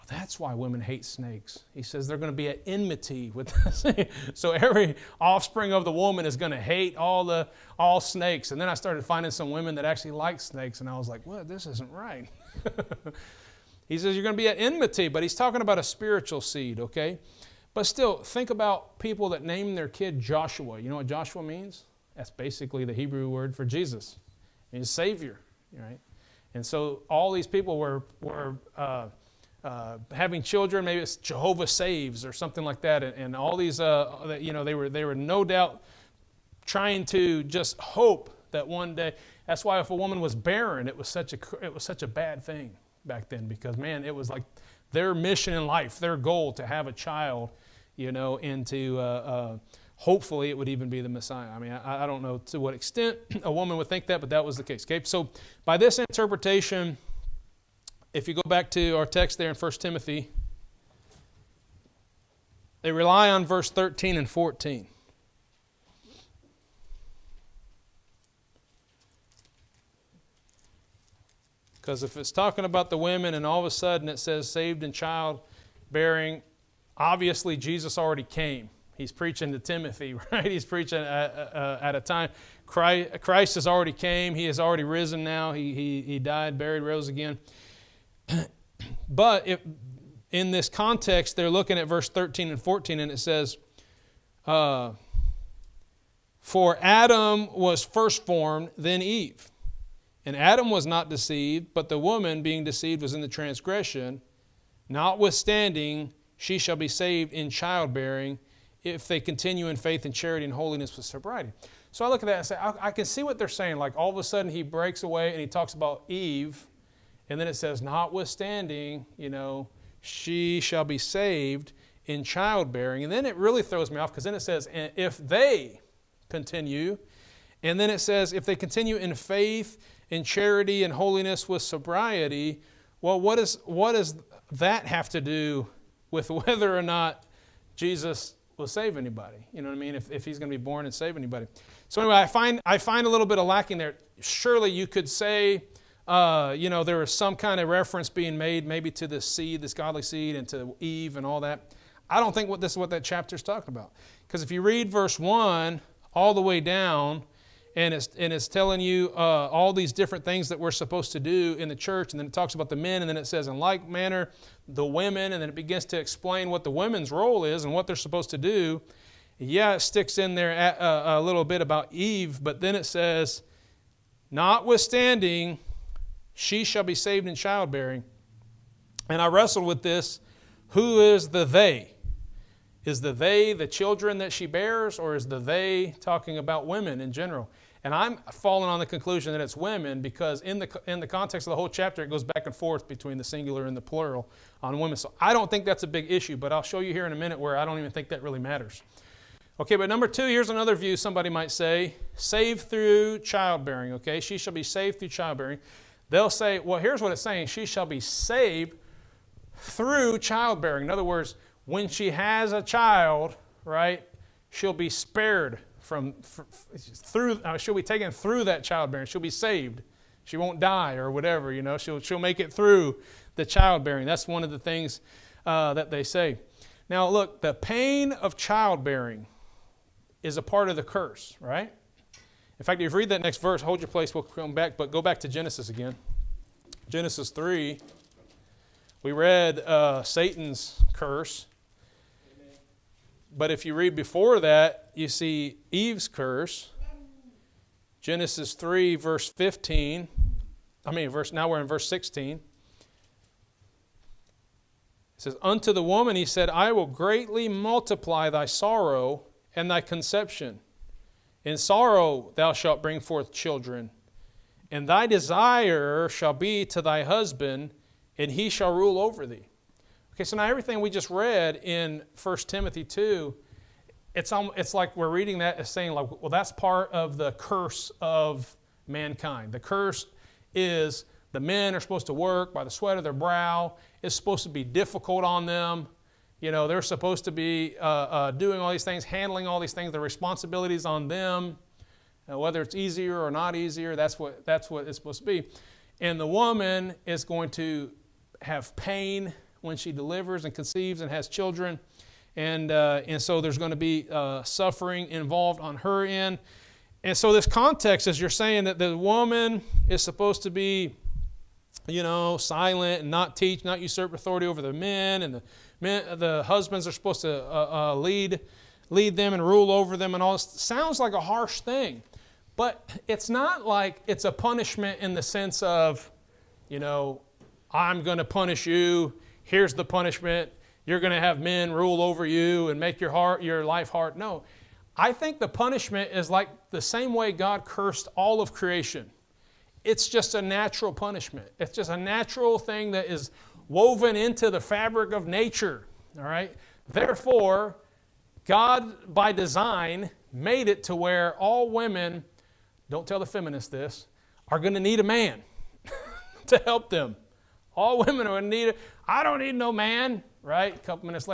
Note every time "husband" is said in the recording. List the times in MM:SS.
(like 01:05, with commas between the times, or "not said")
04:27, 05:16.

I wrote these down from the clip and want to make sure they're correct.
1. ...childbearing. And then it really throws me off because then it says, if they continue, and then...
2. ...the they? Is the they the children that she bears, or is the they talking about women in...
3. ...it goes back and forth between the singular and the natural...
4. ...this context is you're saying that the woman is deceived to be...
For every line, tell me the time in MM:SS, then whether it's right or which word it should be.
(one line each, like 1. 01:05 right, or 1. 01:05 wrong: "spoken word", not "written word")
1. 02:02 right
2. 03:01 right
3. 03:12 wrong: "plural", not "natural"
4. 05:07 wrong: "supposed", not "deceived".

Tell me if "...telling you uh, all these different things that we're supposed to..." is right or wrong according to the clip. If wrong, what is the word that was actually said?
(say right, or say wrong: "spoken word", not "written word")
right.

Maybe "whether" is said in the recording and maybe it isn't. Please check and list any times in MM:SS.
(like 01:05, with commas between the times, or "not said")
02:16, 04:52.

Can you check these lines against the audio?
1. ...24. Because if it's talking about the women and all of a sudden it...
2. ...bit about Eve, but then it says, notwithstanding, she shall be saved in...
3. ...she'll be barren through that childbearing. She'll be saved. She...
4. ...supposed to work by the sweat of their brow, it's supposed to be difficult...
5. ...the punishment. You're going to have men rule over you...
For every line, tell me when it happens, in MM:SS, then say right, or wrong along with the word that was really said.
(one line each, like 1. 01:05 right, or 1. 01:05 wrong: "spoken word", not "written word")
1. 01:04 wrong: "14", not "24"
2. 02:51 right
3. 03:37 wrong: "taken", not "barren"
4. 04:41 right
5. 05:29 right.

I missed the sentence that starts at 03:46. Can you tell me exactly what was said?
Now, look, the pain of childbearing is a part of the curse, right?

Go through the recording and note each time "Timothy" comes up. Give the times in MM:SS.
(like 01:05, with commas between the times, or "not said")
00:59, 01:19, 04:32.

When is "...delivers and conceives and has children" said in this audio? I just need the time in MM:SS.
04:59.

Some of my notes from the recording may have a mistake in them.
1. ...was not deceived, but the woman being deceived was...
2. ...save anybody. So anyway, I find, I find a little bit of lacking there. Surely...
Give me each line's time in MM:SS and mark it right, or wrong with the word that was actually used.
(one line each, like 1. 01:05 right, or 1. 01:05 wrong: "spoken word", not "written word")
1. 01:40 right
2. 02:20 right.